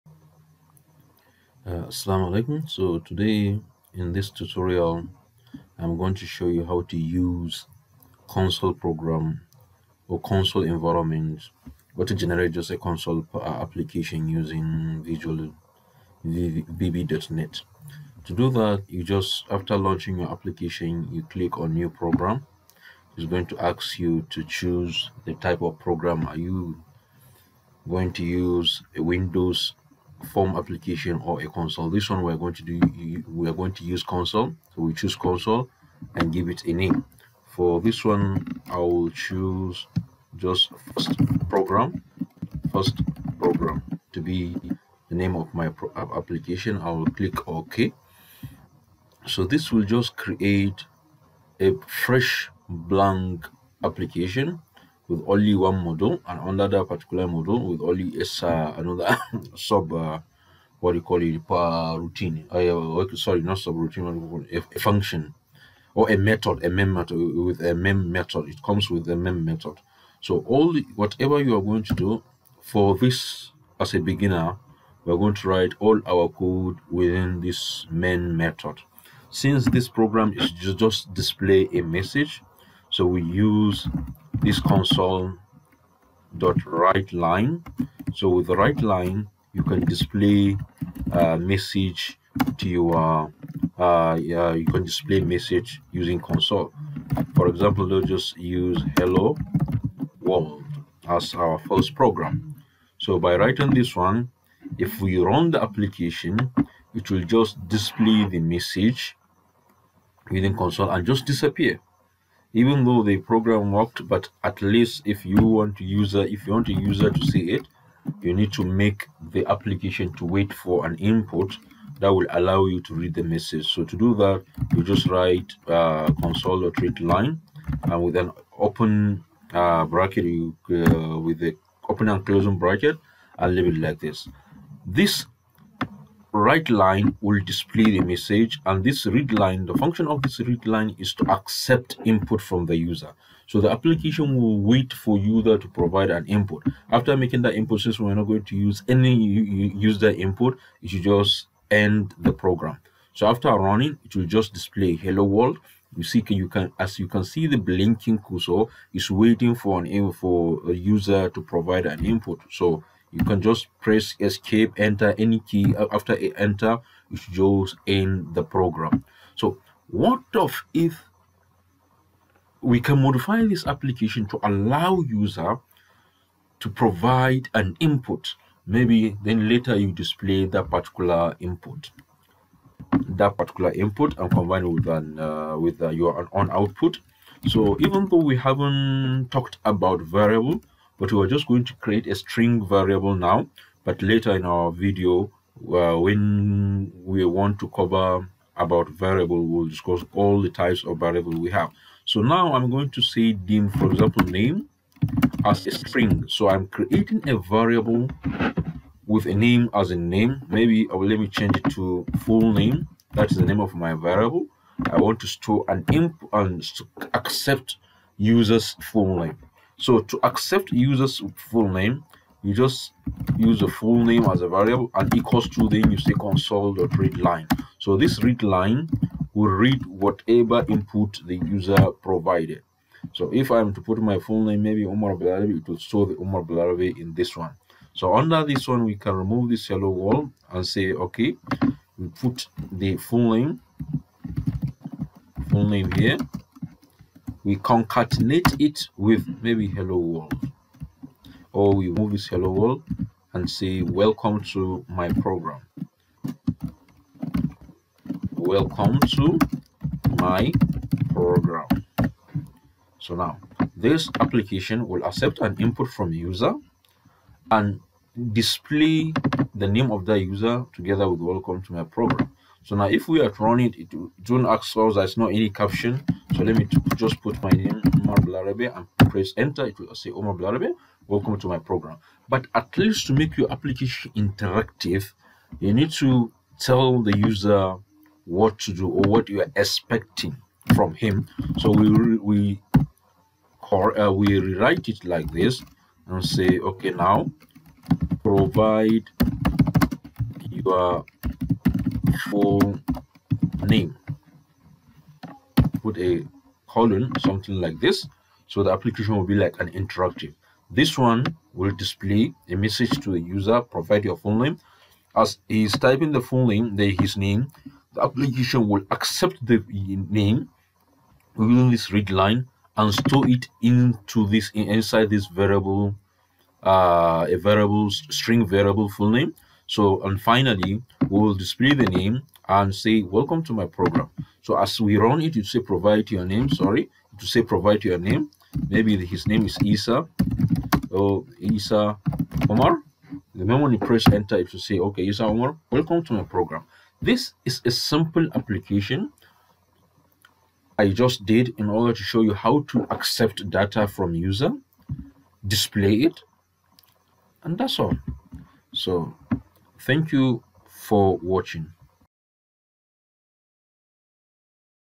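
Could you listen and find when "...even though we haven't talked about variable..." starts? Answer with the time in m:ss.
3:07.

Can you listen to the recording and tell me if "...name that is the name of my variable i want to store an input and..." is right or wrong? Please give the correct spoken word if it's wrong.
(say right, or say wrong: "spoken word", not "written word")
right.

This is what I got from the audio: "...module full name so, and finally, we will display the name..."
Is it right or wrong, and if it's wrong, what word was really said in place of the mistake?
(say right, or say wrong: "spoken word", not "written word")
wrong: "variable", not "module".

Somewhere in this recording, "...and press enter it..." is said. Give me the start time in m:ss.
4:38.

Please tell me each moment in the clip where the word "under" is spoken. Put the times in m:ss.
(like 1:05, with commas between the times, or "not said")
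0:56, 3:58.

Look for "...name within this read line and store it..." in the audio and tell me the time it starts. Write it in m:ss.
5:19.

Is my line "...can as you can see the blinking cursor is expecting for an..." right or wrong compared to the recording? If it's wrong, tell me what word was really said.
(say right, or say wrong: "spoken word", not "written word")
wrong: "waiting", not "expecting".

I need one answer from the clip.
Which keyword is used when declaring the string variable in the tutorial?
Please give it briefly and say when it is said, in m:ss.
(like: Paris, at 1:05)
dim, at 3:23.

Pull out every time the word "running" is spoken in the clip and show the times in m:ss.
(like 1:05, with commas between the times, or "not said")
2:33, 4:33.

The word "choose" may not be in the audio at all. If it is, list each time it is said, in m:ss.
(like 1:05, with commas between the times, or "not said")
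0:24, 0:34, 0:39.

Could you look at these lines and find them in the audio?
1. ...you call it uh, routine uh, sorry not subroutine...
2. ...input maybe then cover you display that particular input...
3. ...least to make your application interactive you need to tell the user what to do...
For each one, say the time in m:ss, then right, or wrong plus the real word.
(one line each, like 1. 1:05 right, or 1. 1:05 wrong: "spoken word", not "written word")
1. 1:00 right
2. 2:57 wrong: "later", not "cover"
3. 4:42 right.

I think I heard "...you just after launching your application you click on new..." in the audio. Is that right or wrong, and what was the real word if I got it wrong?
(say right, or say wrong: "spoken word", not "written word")
right.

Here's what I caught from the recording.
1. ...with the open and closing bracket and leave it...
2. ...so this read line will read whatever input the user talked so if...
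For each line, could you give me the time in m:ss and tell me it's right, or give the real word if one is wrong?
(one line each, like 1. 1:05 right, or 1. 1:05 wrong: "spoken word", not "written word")
1. 2:11 right
2. 3:47 wrong: "provided", not "talked".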